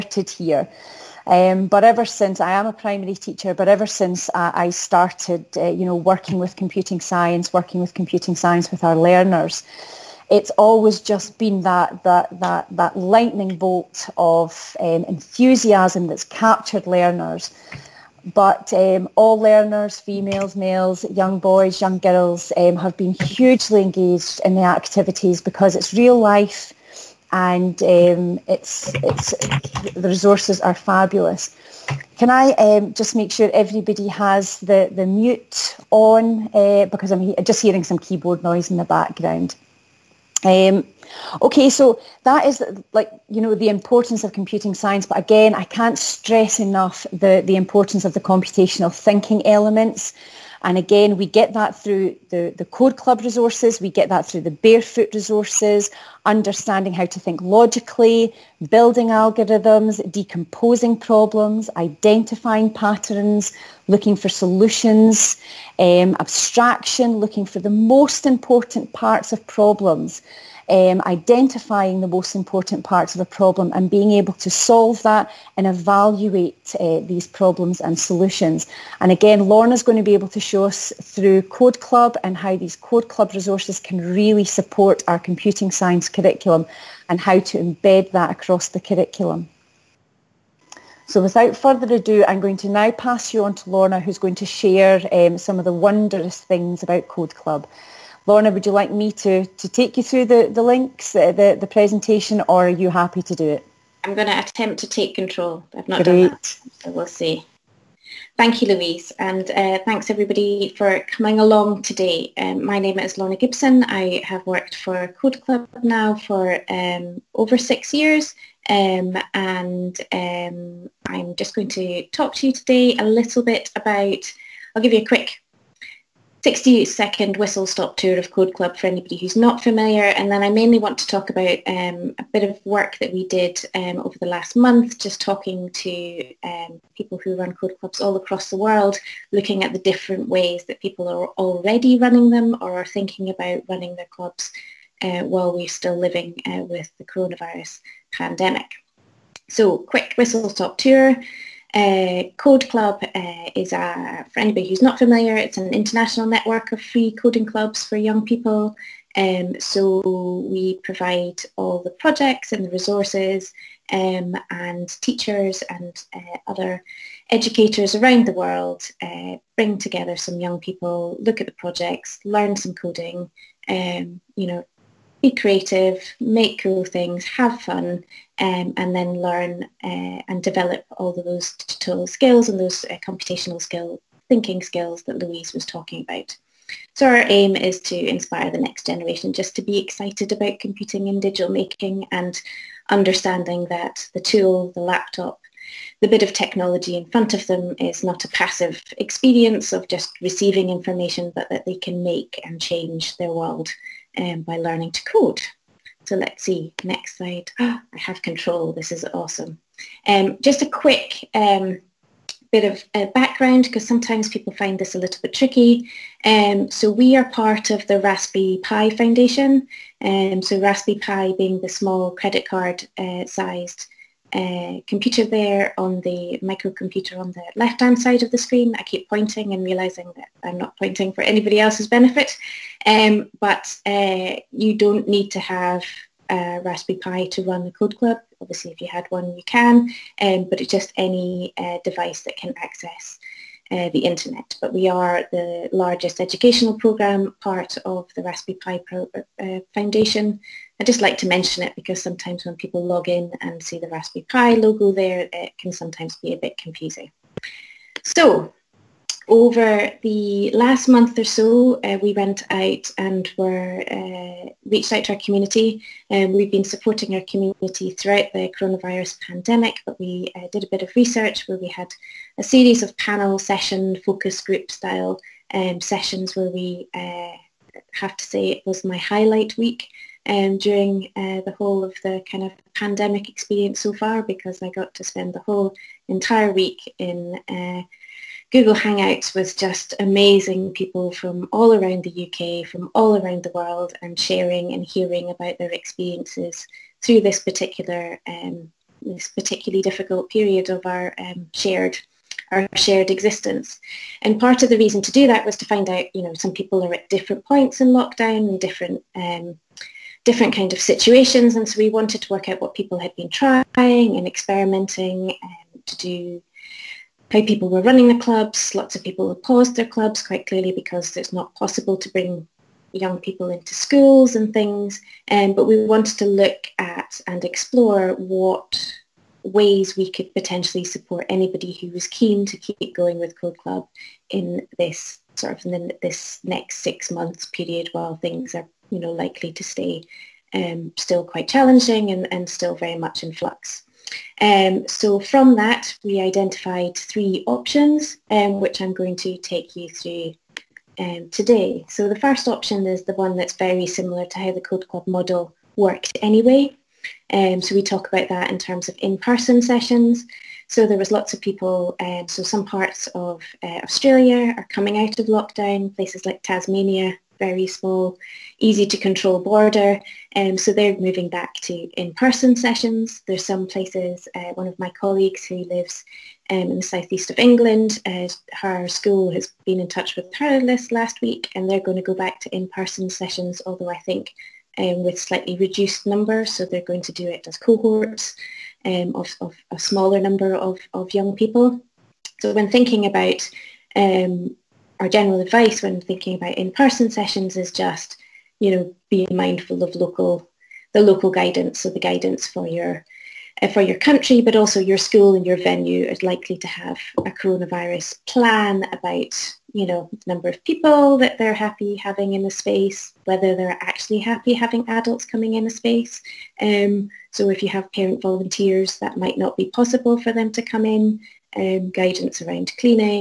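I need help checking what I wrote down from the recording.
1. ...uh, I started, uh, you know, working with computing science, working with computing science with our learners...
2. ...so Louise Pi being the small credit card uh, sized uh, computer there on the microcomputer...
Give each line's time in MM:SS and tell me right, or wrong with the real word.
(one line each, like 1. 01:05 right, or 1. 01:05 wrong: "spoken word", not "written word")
1. 00:04 right
2. 03:40 wrong: "Raspberry", not "Louise".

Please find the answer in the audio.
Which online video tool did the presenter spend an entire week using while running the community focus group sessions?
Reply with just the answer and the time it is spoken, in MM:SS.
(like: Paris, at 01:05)
Google Hangouts, at 04:48.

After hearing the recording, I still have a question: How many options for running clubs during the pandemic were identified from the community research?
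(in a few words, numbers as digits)
3.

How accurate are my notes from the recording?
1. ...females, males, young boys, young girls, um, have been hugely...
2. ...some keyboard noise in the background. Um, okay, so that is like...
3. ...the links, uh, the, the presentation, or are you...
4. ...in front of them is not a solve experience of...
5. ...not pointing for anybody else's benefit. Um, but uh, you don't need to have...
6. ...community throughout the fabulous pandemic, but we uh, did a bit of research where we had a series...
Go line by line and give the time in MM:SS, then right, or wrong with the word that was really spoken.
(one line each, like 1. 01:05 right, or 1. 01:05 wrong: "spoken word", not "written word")
1. 00:19 right
2. 00:37 right
3. 01:40 right
4. 03:16 wrong: "passive", not "solve"
5. 03:50 right
6. 04:27 wrong: "coronavirus", not "fabulous".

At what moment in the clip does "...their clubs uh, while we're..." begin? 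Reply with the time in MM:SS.
02:23.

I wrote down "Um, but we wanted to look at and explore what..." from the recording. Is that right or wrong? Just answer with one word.
right.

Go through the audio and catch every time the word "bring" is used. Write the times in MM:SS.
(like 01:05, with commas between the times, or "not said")
02:49, 05:22.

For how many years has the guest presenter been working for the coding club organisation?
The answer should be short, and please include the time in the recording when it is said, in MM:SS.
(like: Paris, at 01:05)
6, at 01:57.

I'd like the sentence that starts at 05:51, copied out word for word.
So the first option is the one that's very similar to how the Code Club model worked anyway.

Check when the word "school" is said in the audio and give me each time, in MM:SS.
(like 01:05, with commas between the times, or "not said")
05:23, 06:18, 06:44.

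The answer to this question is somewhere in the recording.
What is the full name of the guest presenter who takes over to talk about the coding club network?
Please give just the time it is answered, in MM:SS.
01:53.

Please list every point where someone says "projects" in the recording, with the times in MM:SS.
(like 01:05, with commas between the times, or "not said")
02:41, 02:51.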